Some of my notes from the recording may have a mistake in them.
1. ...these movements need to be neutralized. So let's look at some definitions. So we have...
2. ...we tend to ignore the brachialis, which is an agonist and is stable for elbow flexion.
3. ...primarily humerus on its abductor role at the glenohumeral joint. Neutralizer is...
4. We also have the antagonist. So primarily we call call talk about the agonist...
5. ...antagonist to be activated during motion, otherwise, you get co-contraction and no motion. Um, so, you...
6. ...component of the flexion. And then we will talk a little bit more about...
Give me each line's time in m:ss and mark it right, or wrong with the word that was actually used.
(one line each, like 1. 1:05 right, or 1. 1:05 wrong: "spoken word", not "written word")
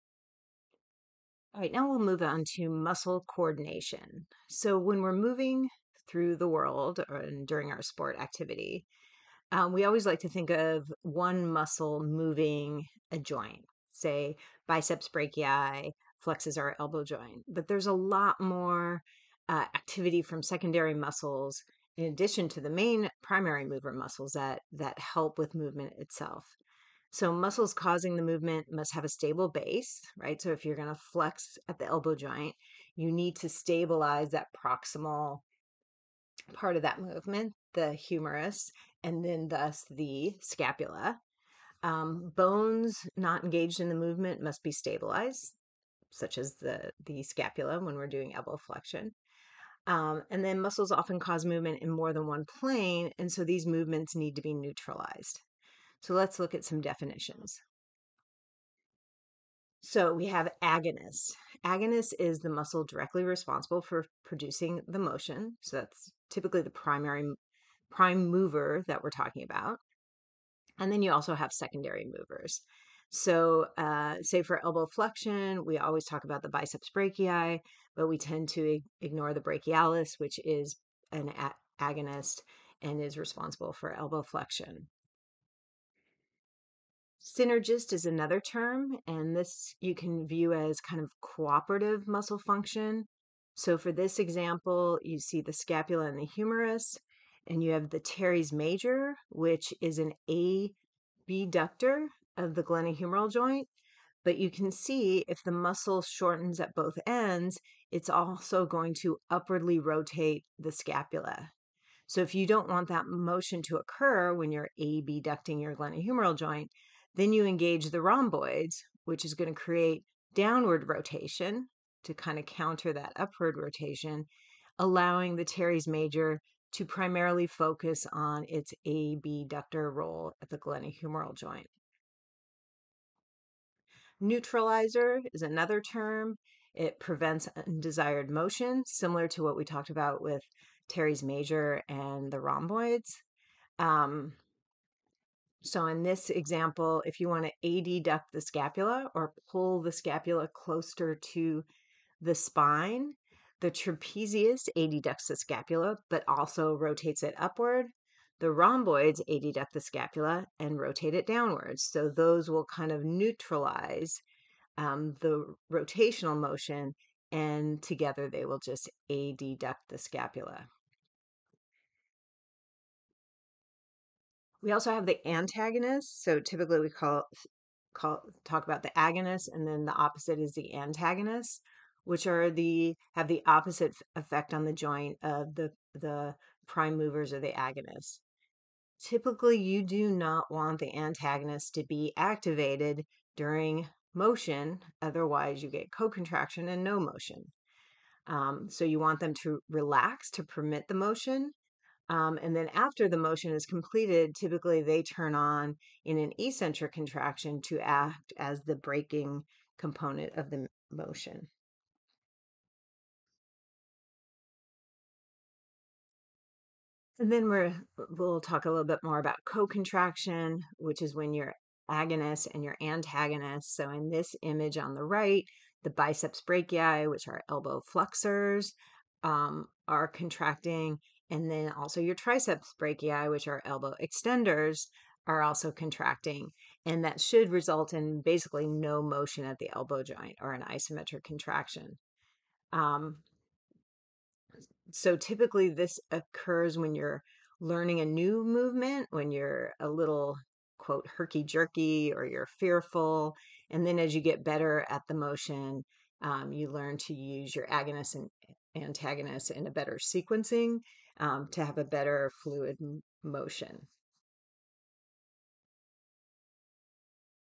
1. 0:53 right
2. 1:18 wrong: "responsible", not "stable"
3. 2:06 wrong: "focus", not "humerus"
4. 2:54 wrong: "typically", not "primarily"
5. 3:10 right
6. 3:29 wrong: "motion", not "flexion".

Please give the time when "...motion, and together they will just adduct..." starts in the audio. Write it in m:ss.
2:46.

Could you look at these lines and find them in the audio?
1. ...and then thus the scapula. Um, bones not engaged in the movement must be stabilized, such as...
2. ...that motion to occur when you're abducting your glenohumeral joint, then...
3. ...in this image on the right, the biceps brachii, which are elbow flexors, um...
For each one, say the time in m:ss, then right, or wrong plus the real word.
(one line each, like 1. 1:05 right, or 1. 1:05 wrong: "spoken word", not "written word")
1. 0:39 right
2. 1:52 right
3. 3:43 right.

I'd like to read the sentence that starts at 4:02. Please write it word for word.
Um, so typically, this occurs when you're learning a new movement, when you're a little quote herky jerky or you're fearful.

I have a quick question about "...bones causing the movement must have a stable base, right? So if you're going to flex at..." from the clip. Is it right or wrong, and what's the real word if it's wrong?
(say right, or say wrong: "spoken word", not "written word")
wrong: "muscles", not "bones".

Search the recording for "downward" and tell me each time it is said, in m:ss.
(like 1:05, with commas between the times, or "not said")
2:00, 2:41.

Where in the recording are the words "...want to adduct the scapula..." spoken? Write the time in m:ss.
2:27.